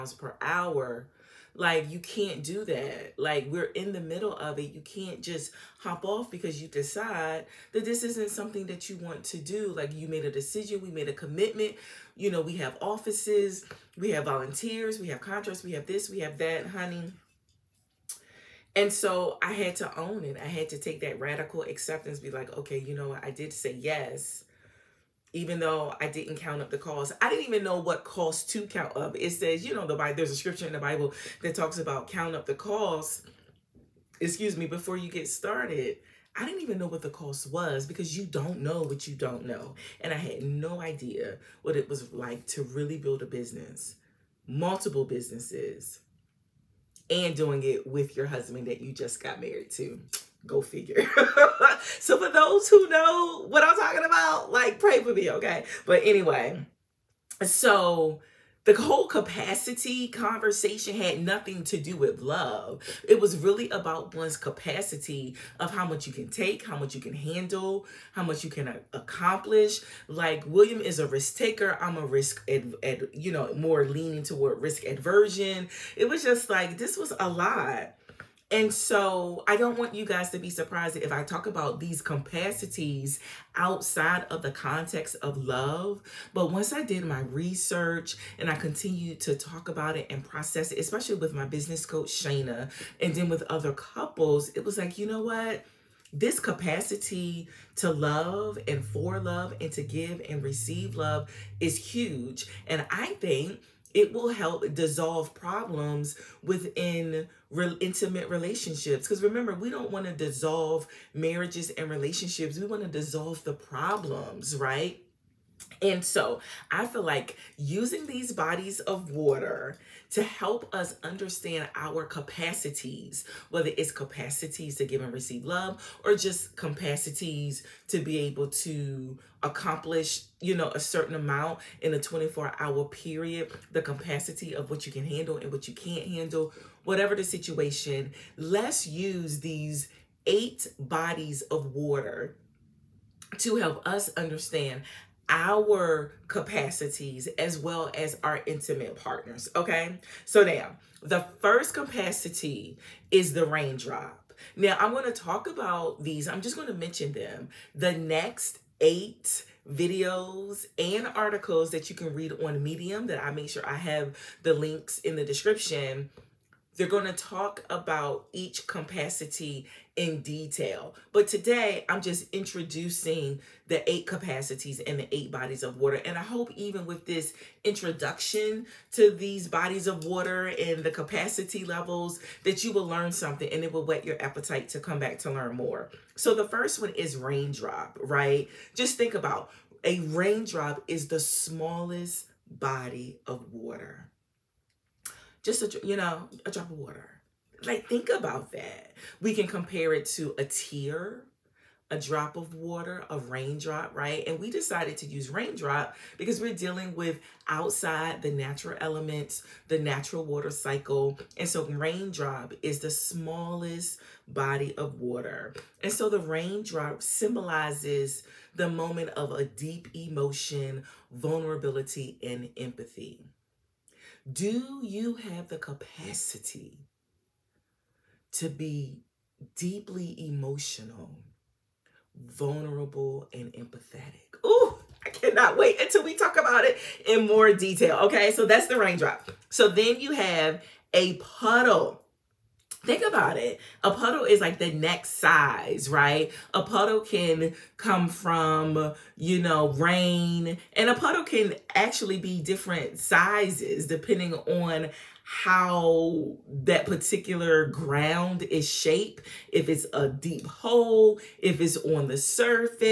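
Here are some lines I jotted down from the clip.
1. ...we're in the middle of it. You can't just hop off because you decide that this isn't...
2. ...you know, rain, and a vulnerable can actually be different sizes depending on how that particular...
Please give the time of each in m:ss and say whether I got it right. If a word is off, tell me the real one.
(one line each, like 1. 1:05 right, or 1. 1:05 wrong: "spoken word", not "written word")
1. 0:03 right
2. 4:09 wrong: "puddle", not "vulnerable".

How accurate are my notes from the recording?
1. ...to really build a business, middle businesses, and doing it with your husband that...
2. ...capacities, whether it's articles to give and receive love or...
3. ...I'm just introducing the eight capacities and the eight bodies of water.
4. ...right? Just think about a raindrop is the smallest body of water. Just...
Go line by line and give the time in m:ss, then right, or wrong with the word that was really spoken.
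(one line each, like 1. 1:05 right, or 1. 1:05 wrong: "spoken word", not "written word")
1. 0:42 wrong: "multiple", not "middle"
2. 2:02 wrong: "capacities", not "articles"
3. 2:51 right
4. 3:08 right.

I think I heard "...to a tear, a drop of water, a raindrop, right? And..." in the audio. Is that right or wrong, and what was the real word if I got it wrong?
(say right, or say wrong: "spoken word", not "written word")
right.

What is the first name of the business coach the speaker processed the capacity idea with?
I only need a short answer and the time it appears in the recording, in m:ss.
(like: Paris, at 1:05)
Shayna, at 1:32.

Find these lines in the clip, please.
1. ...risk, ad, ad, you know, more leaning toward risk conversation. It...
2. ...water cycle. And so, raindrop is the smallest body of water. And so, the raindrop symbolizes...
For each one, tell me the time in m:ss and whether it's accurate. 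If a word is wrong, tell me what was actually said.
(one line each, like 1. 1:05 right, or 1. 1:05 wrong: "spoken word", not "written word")
1. 1:12 wrong: "aversion", not "conversation"
2. 3:30 right.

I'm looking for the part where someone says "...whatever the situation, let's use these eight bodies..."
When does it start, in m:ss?
2:16.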